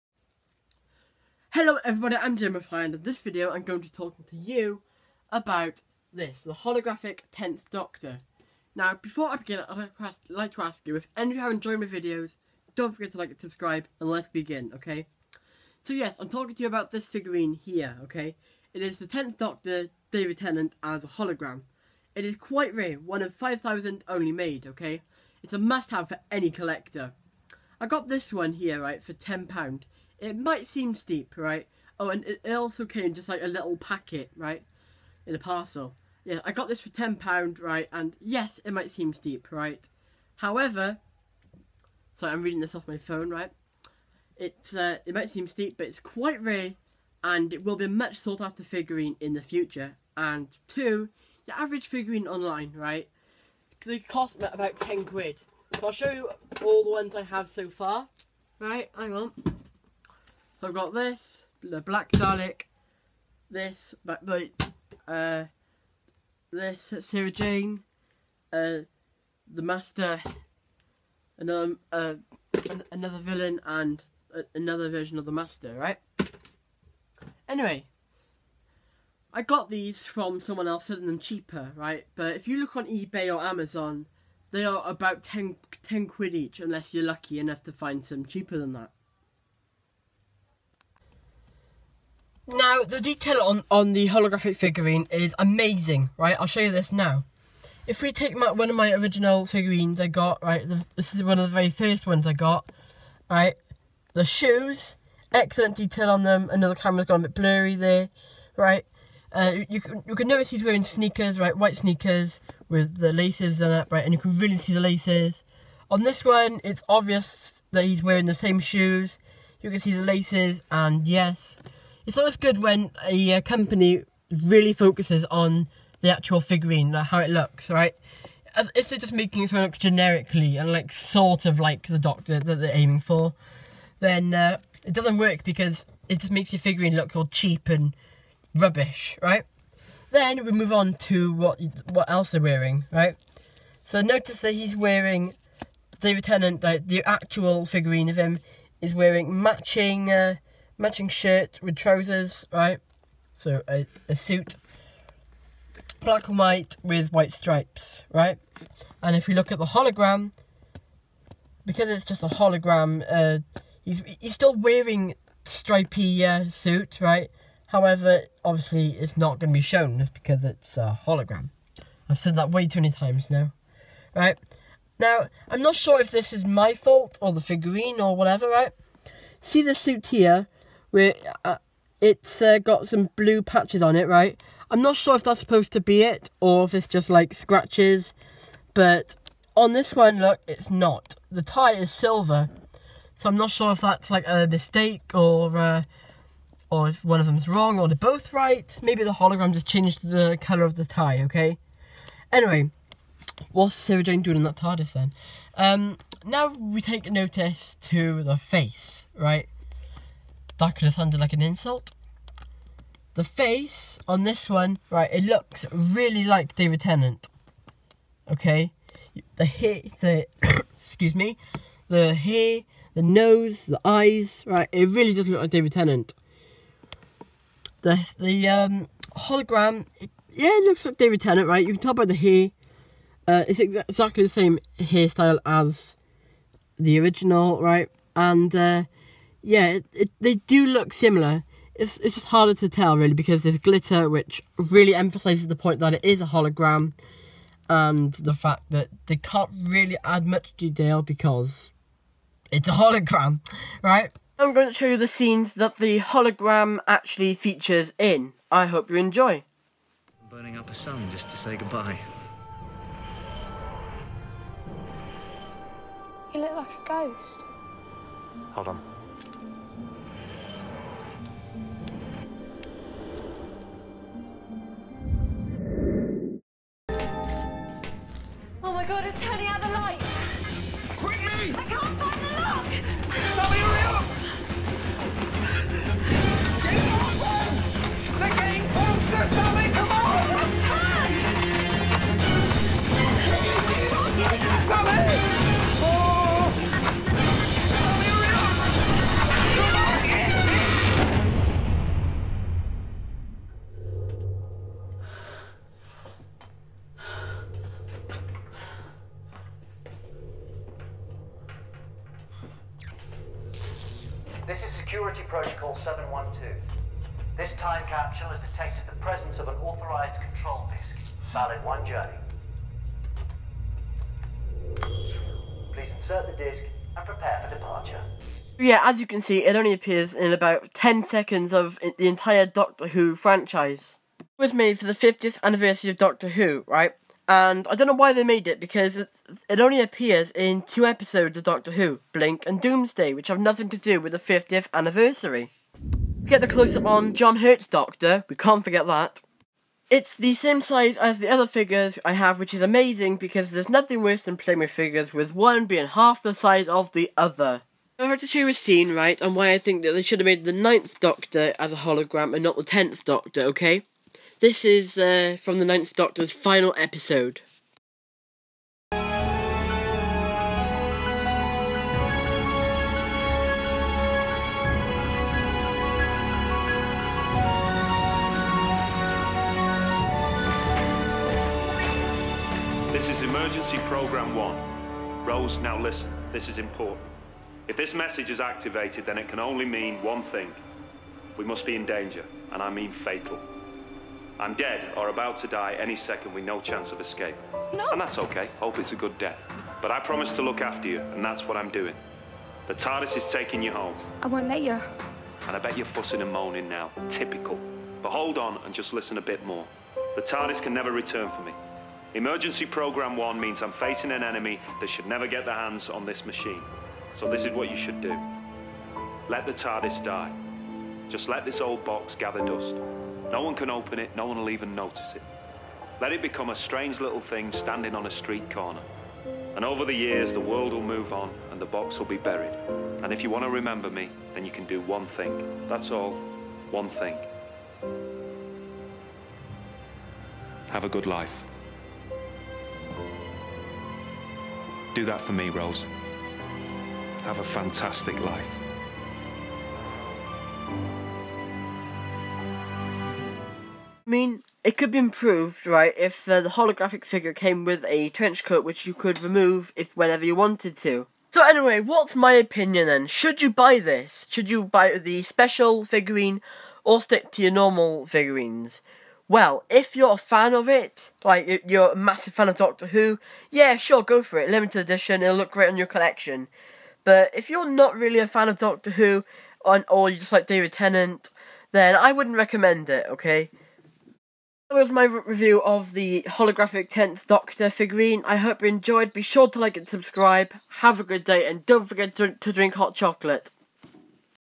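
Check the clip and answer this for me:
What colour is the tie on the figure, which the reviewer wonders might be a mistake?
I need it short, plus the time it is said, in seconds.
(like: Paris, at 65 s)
Silver, at 191 s.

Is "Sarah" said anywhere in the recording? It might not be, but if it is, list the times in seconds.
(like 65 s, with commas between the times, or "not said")
66 s, 203 s.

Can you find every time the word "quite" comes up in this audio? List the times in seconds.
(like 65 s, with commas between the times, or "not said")
22 s, 45 s.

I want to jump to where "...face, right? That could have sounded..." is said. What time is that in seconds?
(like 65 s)
208 s.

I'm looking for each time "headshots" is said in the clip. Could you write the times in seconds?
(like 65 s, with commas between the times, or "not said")
not said.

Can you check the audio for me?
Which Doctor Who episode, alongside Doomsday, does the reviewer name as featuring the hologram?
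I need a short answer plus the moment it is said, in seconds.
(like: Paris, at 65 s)
Blink, at 342 s.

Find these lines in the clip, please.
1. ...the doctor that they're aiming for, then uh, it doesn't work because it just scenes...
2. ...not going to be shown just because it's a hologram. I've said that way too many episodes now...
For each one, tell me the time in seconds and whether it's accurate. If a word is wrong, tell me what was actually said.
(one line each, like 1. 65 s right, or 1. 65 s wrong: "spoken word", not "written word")
1. 131 s wrong: "makes", not "scenes"
2. 169 s wrong: "times", not "episodes".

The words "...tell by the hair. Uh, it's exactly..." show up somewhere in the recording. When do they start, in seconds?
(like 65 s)
231 s.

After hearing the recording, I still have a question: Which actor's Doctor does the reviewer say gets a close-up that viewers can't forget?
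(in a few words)
John Hurt.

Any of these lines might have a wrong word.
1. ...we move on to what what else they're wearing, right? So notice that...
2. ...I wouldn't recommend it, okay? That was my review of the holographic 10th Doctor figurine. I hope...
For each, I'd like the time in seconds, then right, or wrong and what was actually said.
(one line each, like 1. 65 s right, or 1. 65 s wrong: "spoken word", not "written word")
1. 140 s right
2. 481 s right.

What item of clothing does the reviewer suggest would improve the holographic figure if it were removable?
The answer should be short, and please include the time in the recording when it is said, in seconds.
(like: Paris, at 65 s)
Trench coat, at 458 s.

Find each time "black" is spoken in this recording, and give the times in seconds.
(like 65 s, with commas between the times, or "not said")
61 s, 156 s.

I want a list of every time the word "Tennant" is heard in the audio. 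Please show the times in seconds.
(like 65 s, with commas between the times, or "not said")
20 s, 146 s, 216 s, 225 s, 231 s, 480 s.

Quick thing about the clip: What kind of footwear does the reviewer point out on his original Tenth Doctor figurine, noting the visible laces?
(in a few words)
White sneakers.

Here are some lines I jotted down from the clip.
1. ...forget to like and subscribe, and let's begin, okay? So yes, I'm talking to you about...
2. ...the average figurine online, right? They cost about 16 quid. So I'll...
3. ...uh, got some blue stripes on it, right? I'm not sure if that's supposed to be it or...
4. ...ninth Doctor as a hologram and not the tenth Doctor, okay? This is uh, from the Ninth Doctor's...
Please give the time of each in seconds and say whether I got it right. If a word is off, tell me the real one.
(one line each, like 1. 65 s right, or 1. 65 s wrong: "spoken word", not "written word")
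1. 12 s right
2. 51 s wrong: "10", not "16"
3. 182 s wrong: "patches", not "stripes"
4. 360 s right.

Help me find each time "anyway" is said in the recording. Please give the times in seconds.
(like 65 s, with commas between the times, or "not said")
77 s, 202 s, 461 s.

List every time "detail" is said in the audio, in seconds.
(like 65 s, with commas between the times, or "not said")
92 s, 105 s, 250 s.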